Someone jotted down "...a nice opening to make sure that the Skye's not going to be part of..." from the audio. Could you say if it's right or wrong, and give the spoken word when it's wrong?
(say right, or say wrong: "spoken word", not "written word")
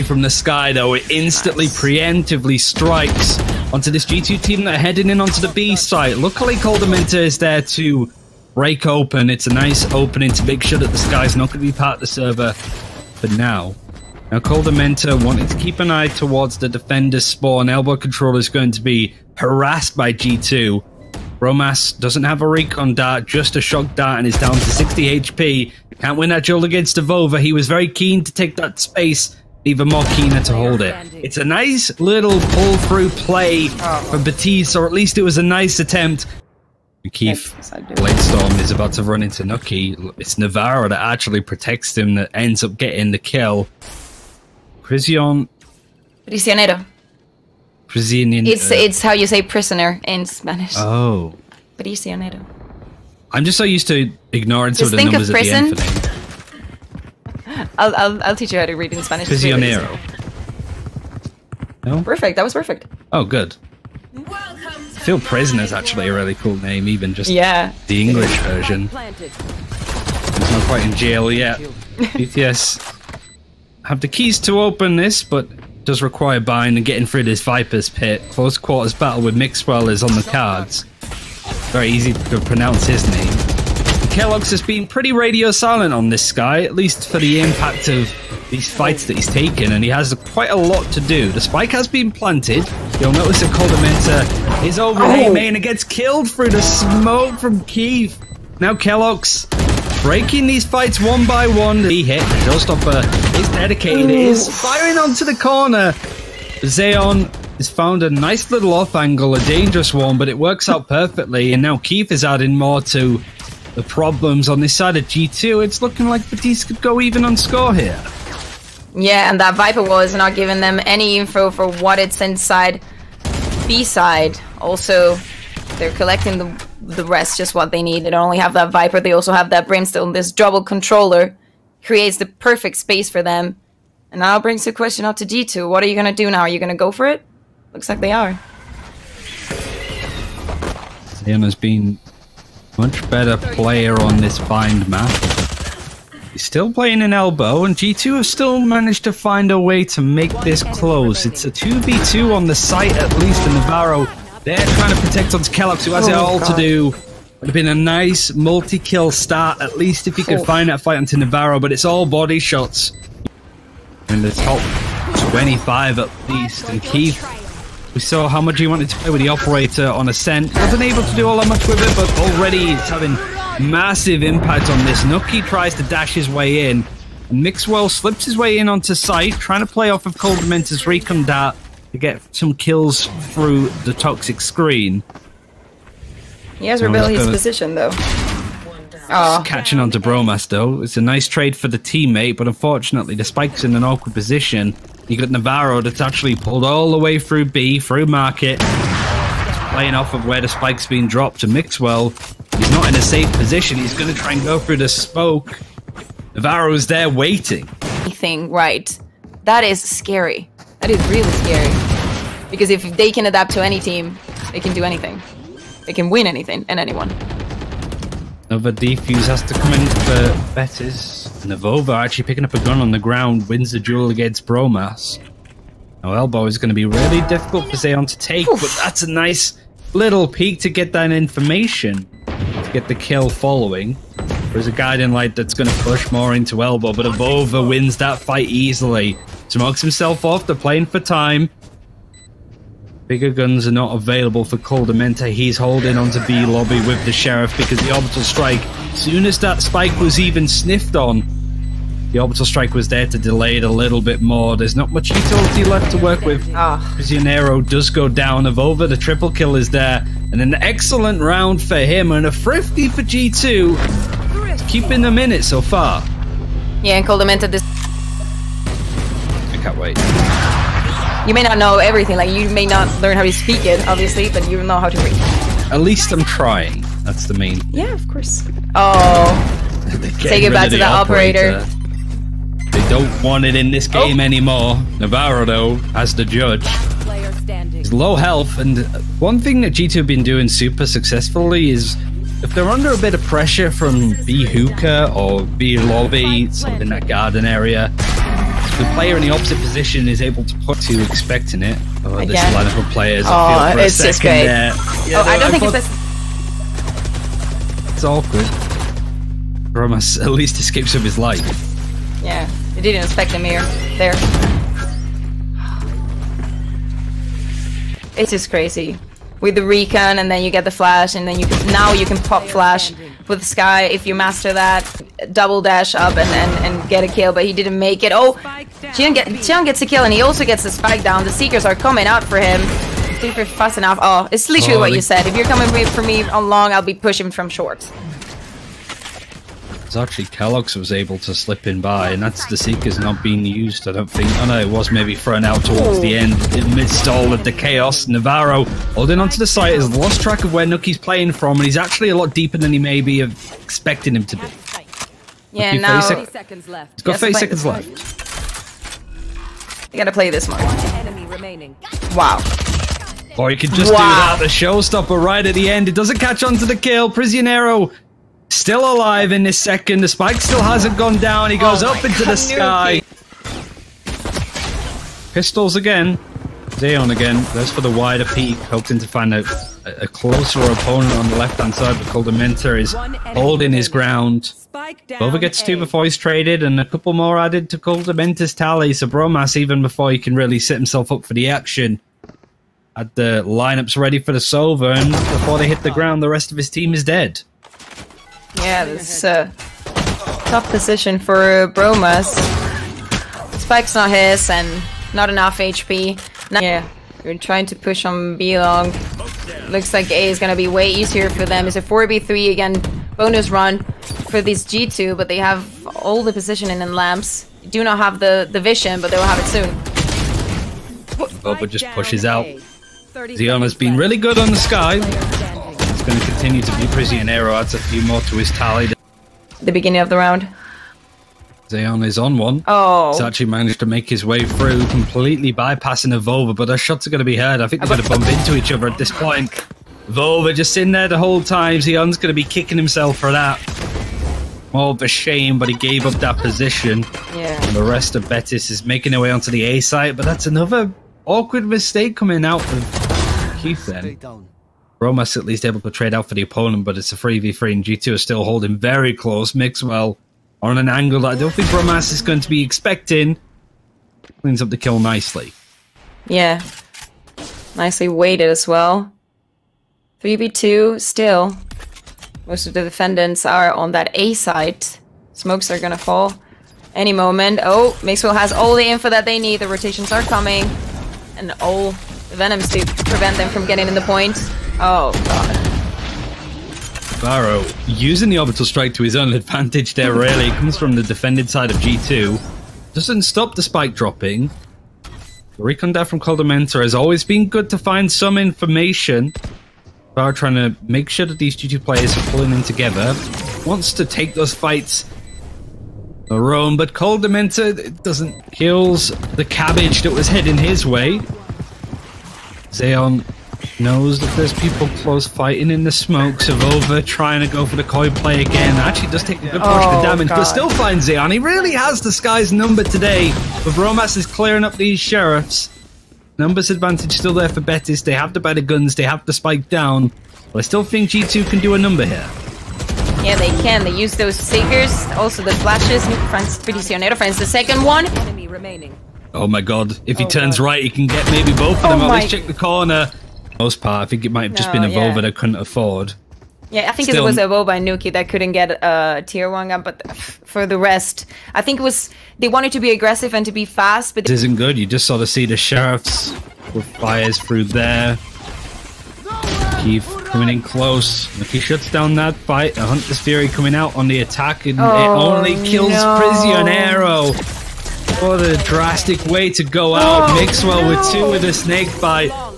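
right.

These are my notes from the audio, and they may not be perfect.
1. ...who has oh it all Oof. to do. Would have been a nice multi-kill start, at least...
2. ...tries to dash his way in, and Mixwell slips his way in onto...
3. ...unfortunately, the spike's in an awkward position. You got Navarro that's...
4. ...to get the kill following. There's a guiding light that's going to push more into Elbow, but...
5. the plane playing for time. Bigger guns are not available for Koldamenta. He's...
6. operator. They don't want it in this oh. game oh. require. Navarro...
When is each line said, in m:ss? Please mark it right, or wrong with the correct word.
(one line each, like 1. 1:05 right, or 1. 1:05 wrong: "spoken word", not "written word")
1. 2:35 wrong: "God", not "Oof"
2. 2:55 right
3. 3:12 right
4. 3:52 right
5. 4:00 right
6. 4:41 wrong: "anymore", not "require".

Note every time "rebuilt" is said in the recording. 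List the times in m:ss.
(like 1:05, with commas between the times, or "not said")
3:06.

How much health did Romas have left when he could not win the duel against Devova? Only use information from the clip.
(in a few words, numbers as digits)
60 HP.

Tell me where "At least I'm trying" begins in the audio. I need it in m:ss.
4:35.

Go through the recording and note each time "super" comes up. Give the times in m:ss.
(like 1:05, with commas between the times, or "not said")
4:50, 5:33.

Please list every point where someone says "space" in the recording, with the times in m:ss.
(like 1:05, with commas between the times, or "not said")
0:28, 2:12.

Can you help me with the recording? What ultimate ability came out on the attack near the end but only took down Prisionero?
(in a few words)
Hunter's Fury.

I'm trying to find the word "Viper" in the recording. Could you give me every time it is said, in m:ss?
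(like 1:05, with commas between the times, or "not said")
1:17, 1:59, 2:08.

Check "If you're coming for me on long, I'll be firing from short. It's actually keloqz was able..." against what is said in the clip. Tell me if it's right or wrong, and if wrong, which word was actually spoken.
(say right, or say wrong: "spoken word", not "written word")
wrong: "pushing", not "firing".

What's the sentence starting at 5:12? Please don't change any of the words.
Yeah, he didn't expect him here.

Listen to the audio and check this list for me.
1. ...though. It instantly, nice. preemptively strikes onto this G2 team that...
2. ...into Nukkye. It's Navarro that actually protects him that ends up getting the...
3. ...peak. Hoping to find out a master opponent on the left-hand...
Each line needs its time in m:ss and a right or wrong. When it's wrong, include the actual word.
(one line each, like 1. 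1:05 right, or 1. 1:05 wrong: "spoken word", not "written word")
1. 0:00 right
2. 0:39 right
3. 6:18 wrong: "closer", not "master".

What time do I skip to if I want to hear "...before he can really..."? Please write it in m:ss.
6:29.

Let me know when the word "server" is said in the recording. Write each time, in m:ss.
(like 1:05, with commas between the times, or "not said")
0:12.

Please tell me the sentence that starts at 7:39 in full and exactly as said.
Mixwell on an angle that I don't think Bromass is going to be expecting.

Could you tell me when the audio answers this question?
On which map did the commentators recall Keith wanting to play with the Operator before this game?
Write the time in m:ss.
2:50.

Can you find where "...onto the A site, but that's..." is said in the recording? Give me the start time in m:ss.
7:29.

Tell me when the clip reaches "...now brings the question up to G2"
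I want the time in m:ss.
2:14.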